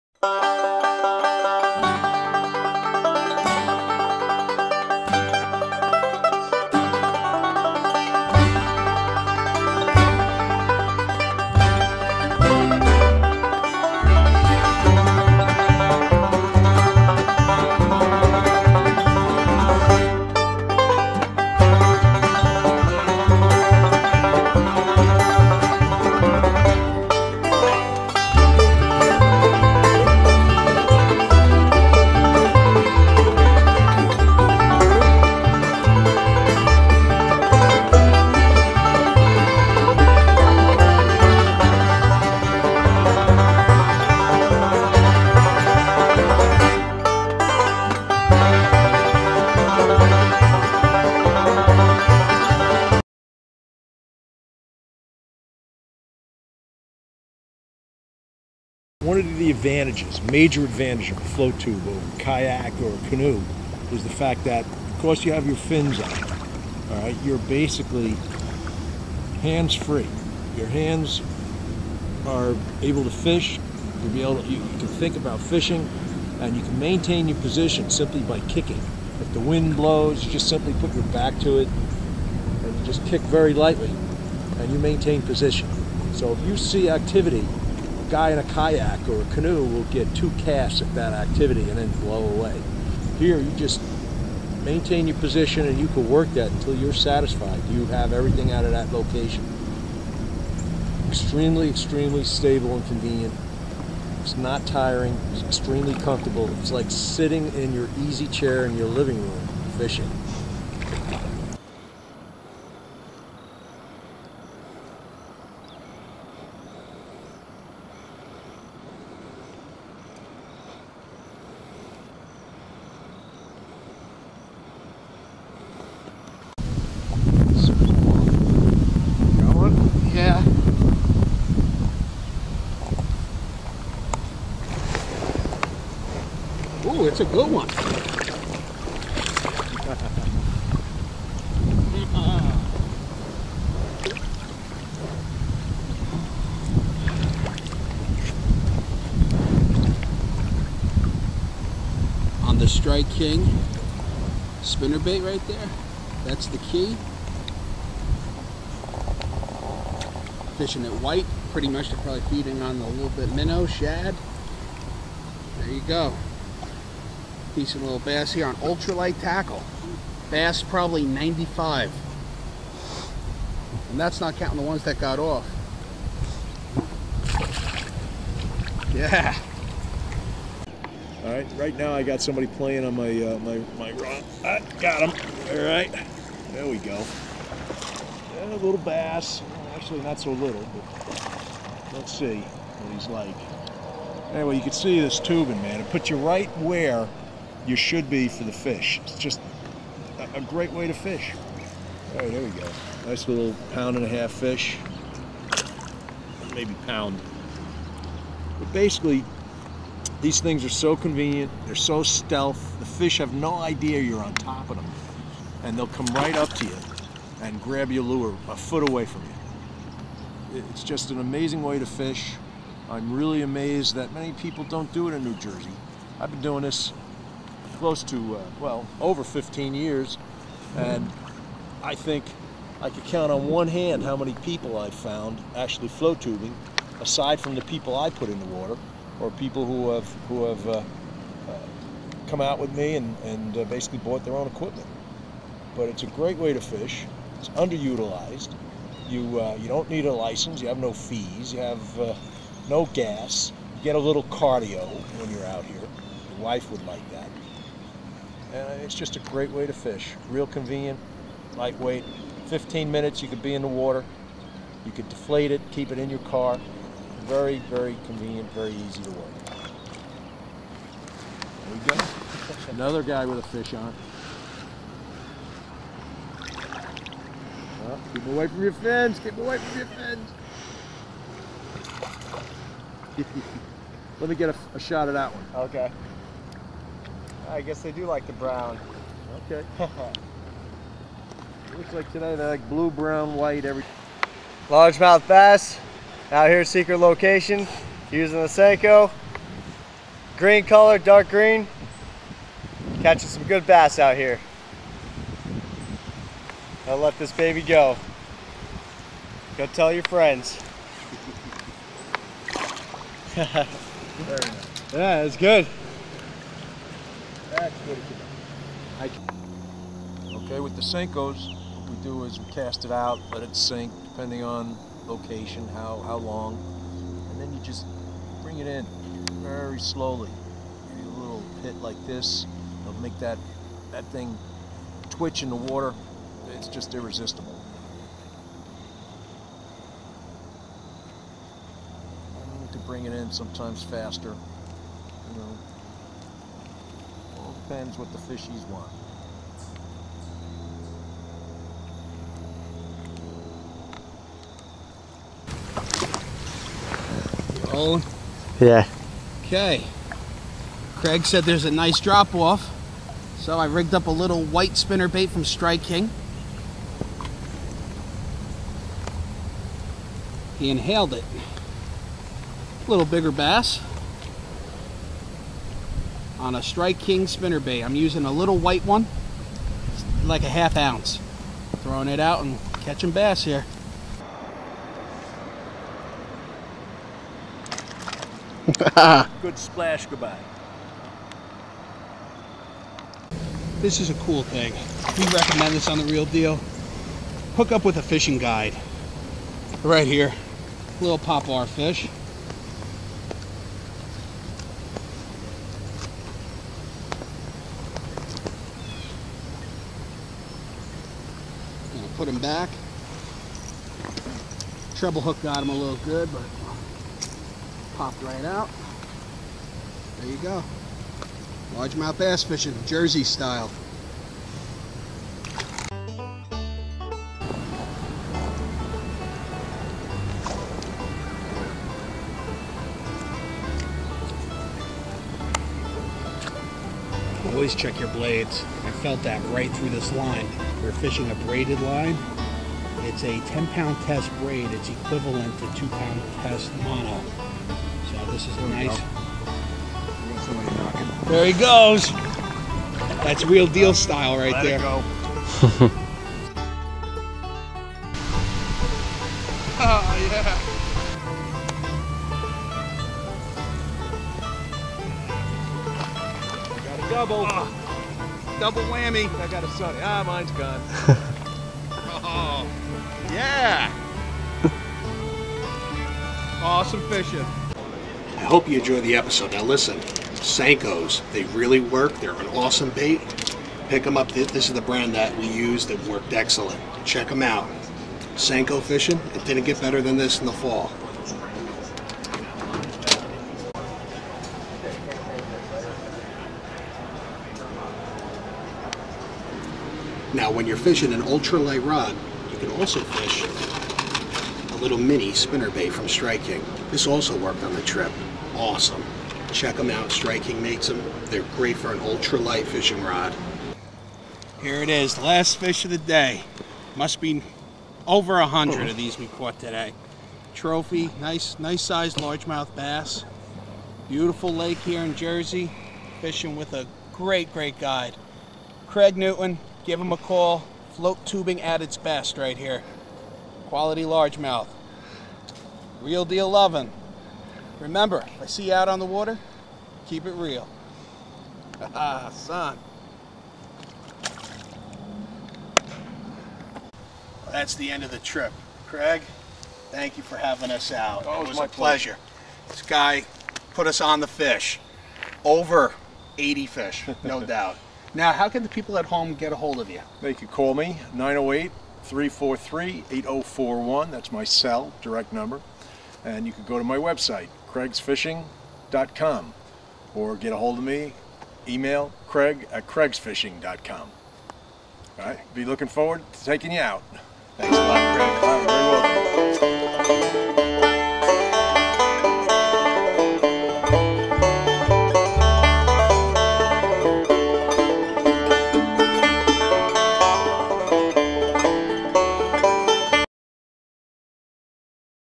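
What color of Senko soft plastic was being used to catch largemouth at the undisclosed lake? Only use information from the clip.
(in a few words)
dark green.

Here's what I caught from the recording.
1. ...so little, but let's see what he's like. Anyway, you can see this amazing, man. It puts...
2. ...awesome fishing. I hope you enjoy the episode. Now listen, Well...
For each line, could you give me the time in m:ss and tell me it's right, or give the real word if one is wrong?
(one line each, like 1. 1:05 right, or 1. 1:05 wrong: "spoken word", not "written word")
1. 3:10 wrong: "tubing", not "amazing"
2. 7:56 wrong: "Senkos", not "Well".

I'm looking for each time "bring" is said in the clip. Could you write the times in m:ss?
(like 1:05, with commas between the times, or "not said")
5:28, 5:42.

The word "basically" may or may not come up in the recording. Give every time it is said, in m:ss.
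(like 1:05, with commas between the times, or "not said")
1:07, 3:28, 4:03.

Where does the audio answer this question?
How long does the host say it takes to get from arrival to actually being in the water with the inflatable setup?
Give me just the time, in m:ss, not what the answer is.
4:22.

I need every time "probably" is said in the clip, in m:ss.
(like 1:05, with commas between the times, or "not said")
2:42, 2:50.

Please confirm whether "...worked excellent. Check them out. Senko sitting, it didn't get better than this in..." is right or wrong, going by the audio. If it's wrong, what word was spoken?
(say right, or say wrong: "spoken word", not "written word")
wrong: "fishing", not "sitting".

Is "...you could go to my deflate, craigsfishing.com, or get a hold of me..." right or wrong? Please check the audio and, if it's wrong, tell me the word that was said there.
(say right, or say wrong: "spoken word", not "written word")
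wrong: "website", not "deflate".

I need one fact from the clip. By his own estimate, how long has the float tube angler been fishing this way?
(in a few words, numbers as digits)
over 15 years.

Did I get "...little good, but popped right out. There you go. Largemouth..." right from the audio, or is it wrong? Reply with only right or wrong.
right.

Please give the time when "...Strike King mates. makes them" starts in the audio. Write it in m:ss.
8:30.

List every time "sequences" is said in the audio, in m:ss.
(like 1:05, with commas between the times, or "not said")
not said.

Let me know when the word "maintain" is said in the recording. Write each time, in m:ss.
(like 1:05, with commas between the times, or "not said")
1:16, 1:24, 1:34.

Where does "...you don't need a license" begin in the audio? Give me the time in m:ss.
4:09.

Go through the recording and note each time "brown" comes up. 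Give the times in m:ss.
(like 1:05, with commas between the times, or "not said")
4:48, 4:52.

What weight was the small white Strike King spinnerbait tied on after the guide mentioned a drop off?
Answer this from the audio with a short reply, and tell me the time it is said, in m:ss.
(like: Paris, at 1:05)
half ounce, at 6:20.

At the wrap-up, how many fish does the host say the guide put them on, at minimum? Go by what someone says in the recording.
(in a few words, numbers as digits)
over 80.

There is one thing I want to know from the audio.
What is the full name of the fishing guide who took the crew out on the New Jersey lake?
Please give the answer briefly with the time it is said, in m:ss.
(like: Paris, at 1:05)
Craig Newton, at 8:48.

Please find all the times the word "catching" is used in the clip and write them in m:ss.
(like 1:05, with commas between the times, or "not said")
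5:03, 6:22.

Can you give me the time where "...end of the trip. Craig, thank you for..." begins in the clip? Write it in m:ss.
9:07.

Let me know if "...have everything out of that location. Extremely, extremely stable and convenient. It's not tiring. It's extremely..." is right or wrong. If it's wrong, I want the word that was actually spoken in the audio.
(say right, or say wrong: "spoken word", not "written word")
right.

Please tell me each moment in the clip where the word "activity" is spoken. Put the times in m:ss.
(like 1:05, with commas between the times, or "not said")
1:26, 1:31.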